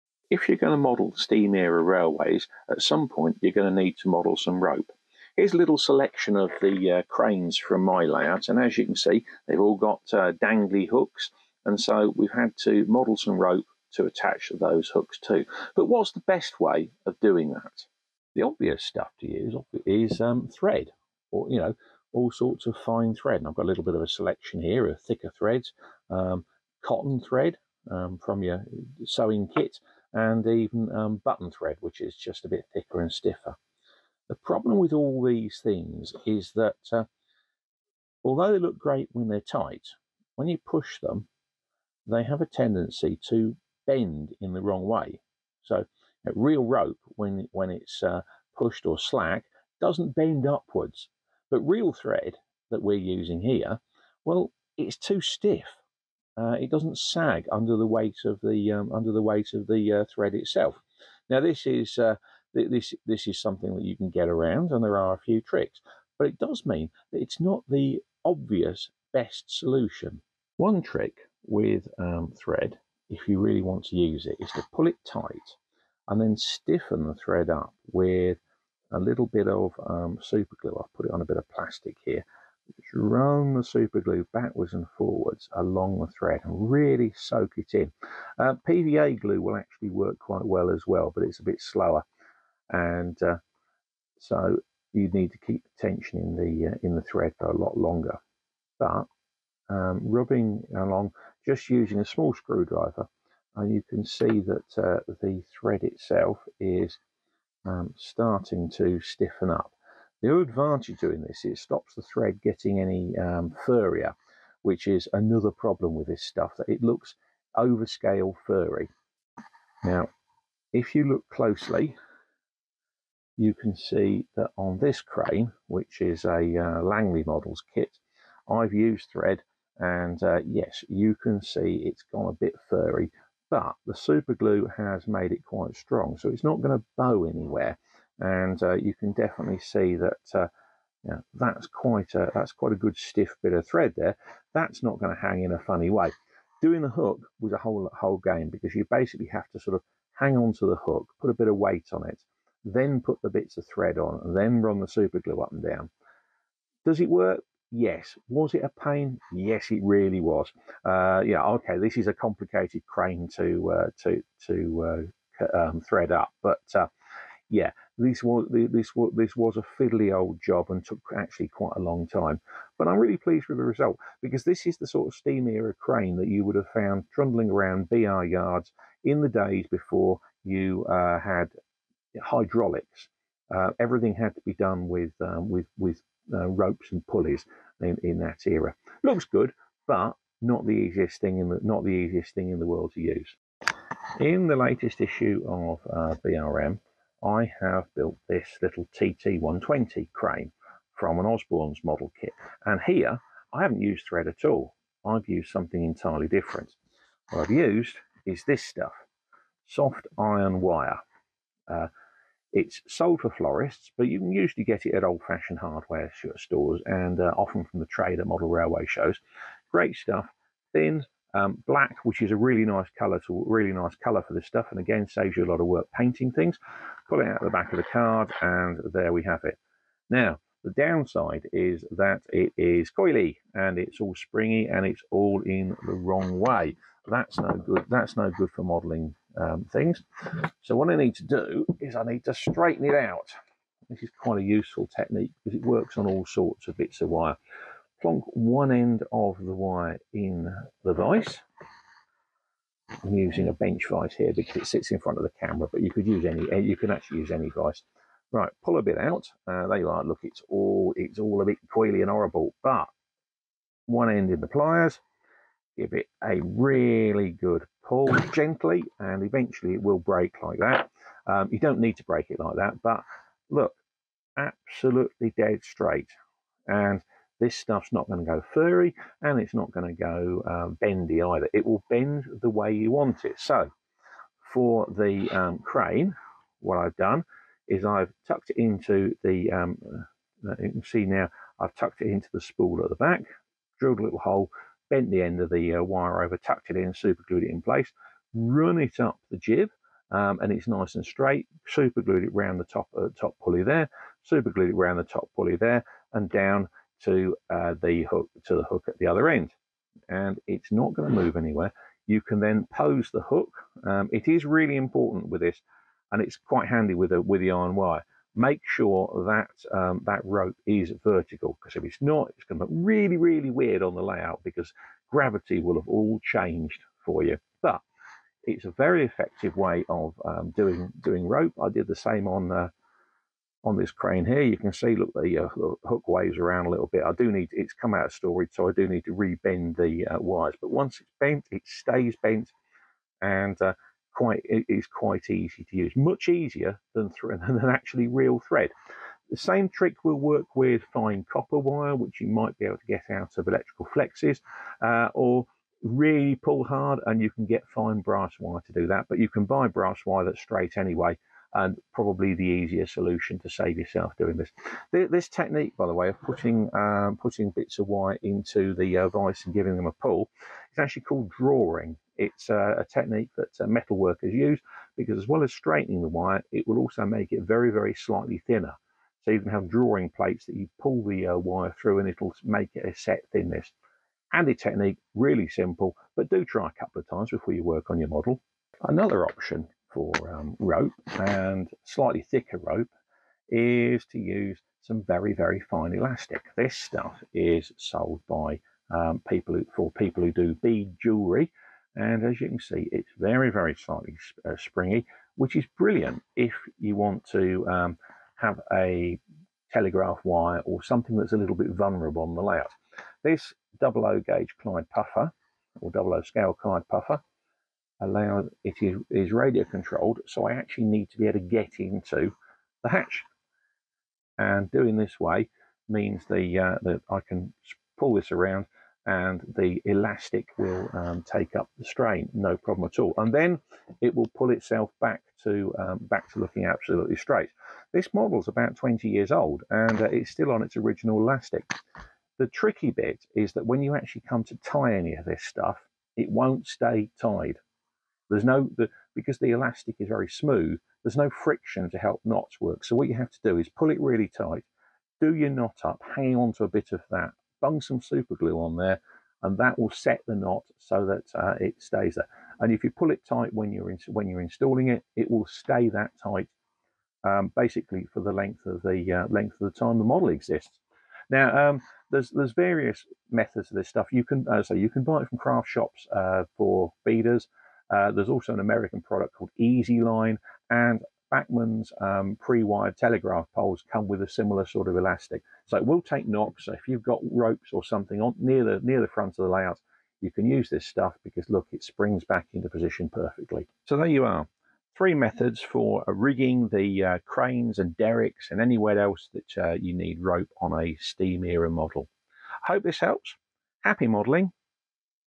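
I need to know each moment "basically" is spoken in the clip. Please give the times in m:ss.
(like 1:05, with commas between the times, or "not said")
2:28, 7:47.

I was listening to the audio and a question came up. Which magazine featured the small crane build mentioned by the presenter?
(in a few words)
BRM.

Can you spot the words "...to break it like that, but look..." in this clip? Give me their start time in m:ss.
4:31.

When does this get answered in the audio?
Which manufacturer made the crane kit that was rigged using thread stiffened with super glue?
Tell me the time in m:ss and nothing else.
2:06.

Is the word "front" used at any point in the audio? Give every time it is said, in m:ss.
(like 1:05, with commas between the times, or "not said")
4:14, 8:09.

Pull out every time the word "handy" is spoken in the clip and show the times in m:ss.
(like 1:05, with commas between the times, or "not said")
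5:16, 6:24.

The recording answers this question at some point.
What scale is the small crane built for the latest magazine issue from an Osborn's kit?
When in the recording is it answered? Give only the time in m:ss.
3:18.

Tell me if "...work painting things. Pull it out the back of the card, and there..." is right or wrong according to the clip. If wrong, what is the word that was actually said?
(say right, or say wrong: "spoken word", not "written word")
right.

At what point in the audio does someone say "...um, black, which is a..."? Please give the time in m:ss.
3:41.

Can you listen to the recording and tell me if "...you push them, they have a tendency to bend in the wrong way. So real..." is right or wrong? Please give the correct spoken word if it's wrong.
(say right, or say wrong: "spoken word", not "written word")
right.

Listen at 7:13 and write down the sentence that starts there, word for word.
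And then it will pull itself back to um, back to looking absolutely straight.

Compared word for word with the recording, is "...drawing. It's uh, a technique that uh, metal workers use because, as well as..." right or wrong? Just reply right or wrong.
right.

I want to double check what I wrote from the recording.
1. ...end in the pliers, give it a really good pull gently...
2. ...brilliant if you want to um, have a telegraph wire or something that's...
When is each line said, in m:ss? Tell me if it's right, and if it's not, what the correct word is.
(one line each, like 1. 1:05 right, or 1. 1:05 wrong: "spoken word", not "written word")
1. 4:24 right
2. 6:45 right.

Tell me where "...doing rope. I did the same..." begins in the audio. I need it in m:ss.
5:31.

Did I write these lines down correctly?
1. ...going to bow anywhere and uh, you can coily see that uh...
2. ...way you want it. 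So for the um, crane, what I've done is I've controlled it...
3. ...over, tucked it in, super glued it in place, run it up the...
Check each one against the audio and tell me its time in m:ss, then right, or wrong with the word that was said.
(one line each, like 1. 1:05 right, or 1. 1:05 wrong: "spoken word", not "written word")
1. 2:16 wrong: "definitely", not "coily"
2. 4:42 wrong: "tucked", not "controlled"
3. 4:56 right.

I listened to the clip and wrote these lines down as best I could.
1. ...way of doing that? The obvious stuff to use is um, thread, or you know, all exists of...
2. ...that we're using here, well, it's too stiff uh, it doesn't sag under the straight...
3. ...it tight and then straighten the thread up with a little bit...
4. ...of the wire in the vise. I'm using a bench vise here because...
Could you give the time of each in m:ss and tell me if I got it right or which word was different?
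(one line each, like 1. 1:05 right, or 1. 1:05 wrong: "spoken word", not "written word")
1. 0:16 wrong: "sorts", not "exists"
2. 0:52 wrong: "weight", not "straight"
3. 1:14 wrong: "stiffen", not "straighten"
4. 4:09 right.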